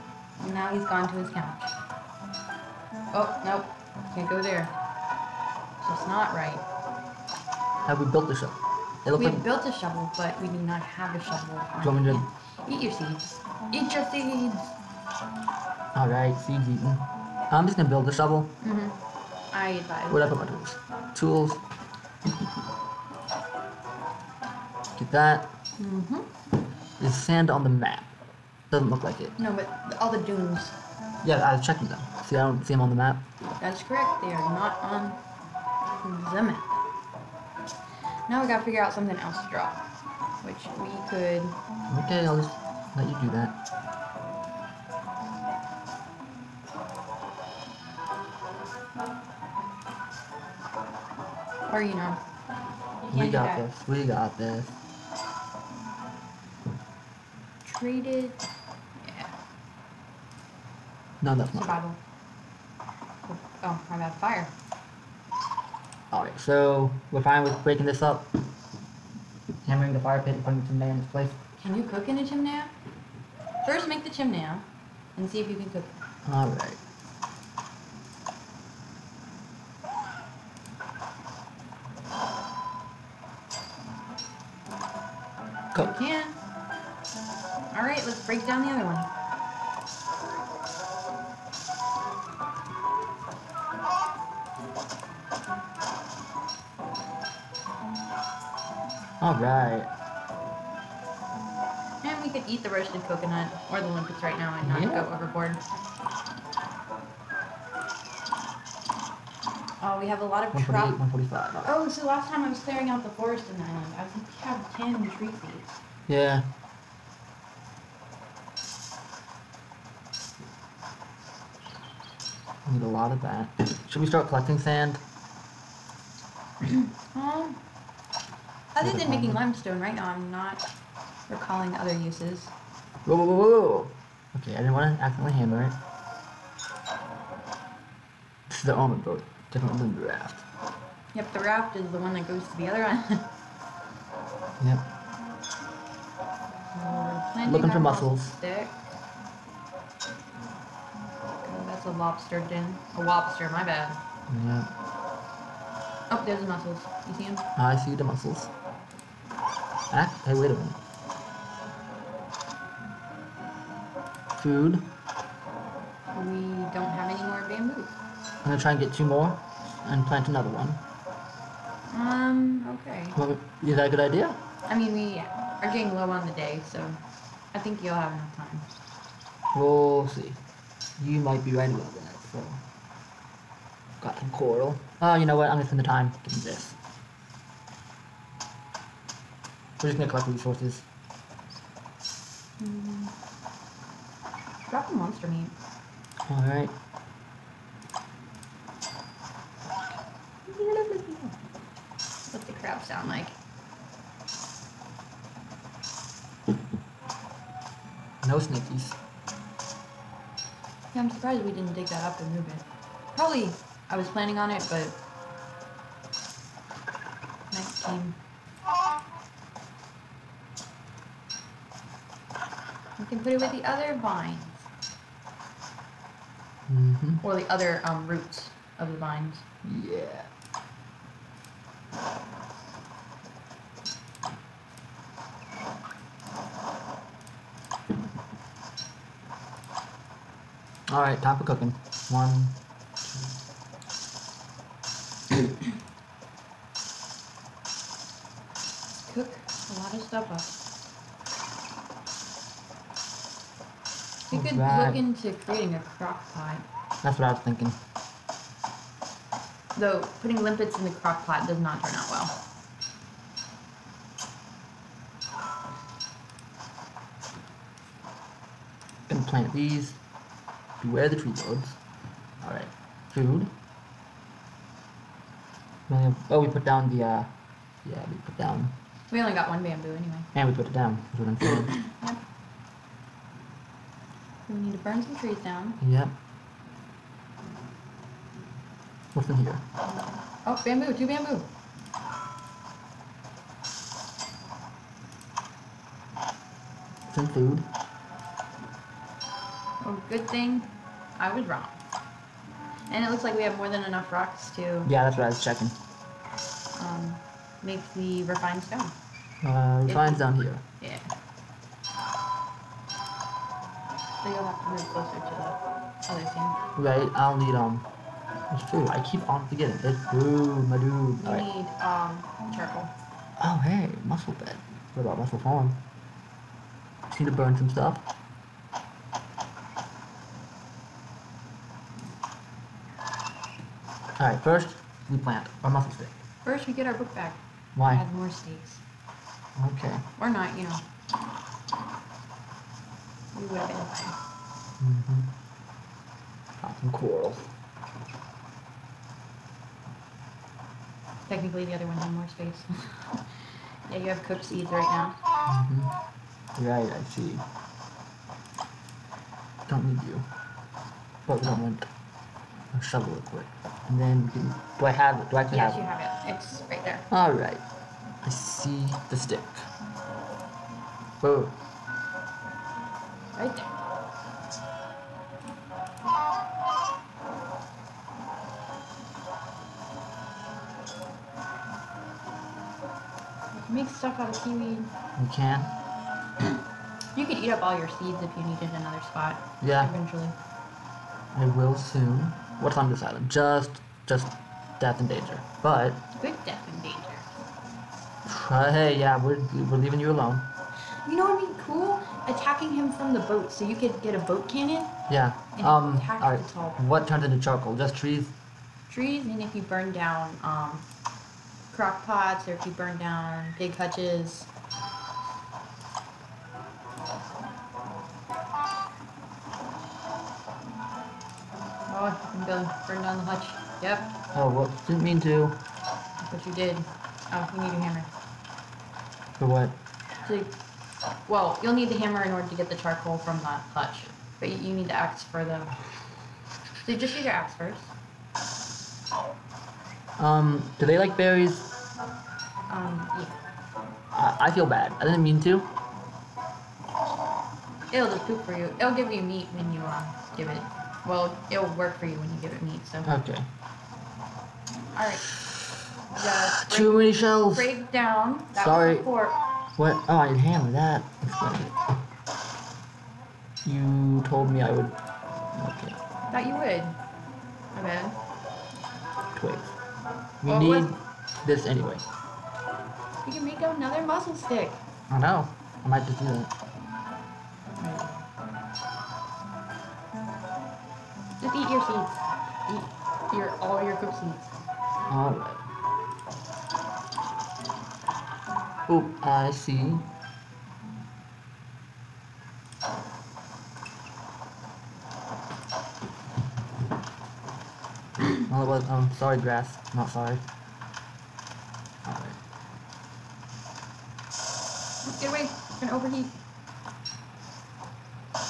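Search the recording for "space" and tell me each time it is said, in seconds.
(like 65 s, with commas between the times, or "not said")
352 s.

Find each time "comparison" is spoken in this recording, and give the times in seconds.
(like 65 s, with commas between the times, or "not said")
not said.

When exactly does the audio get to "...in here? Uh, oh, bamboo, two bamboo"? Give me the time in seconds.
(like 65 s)
289 s.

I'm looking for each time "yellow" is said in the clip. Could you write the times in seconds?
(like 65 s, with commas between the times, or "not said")
not said.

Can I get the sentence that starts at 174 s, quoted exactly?
I mean, we are getting low on the day, so I think you'll have enough time.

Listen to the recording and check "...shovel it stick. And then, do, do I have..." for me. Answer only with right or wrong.
wrong.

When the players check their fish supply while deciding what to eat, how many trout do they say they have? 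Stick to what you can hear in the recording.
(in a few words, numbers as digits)
145.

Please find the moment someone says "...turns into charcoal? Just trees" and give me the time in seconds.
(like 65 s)
407 s.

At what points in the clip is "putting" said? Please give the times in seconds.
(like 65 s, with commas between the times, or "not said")
70 s, 260 s.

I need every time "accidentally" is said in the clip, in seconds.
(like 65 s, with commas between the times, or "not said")
135 s.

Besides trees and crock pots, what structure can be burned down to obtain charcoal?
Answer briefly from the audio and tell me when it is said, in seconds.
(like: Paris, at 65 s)
Pig hutches, at 413 s.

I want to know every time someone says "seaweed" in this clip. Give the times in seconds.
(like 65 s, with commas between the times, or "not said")
384 s.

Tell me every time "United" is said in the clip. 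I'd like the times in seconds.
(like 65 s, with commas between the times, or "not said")
not said.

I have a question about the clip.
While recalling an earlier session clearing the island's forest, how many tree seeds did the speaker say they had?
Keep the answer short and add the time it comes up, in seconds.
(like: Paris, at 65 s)
10, at 114 s.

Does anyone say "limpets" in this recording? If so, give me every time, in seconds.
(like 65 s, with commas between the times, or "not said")
103 s, 260 s.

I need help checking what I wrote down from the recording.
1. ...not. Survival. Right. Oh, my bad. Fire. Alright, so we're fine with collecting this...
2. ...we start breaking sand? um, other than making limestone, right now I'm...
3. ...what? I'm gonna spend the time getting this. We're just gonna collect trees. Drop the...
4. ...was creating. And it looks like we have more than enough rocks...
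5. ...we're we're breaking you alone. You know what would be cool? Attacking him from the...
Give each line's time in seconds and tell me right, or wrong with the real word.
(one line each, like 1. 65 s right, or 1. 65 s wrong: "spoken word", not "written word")
1. 61 s wrong: "breaking", not "collecting"
2. 124 s wrong: "collecting", not "breaking"
3. 185 s wrong: "resources", not "trees"
4. 301 s wrong: "wrong", not "creating"
5. 399 s wrong: "leaving", not "breaking".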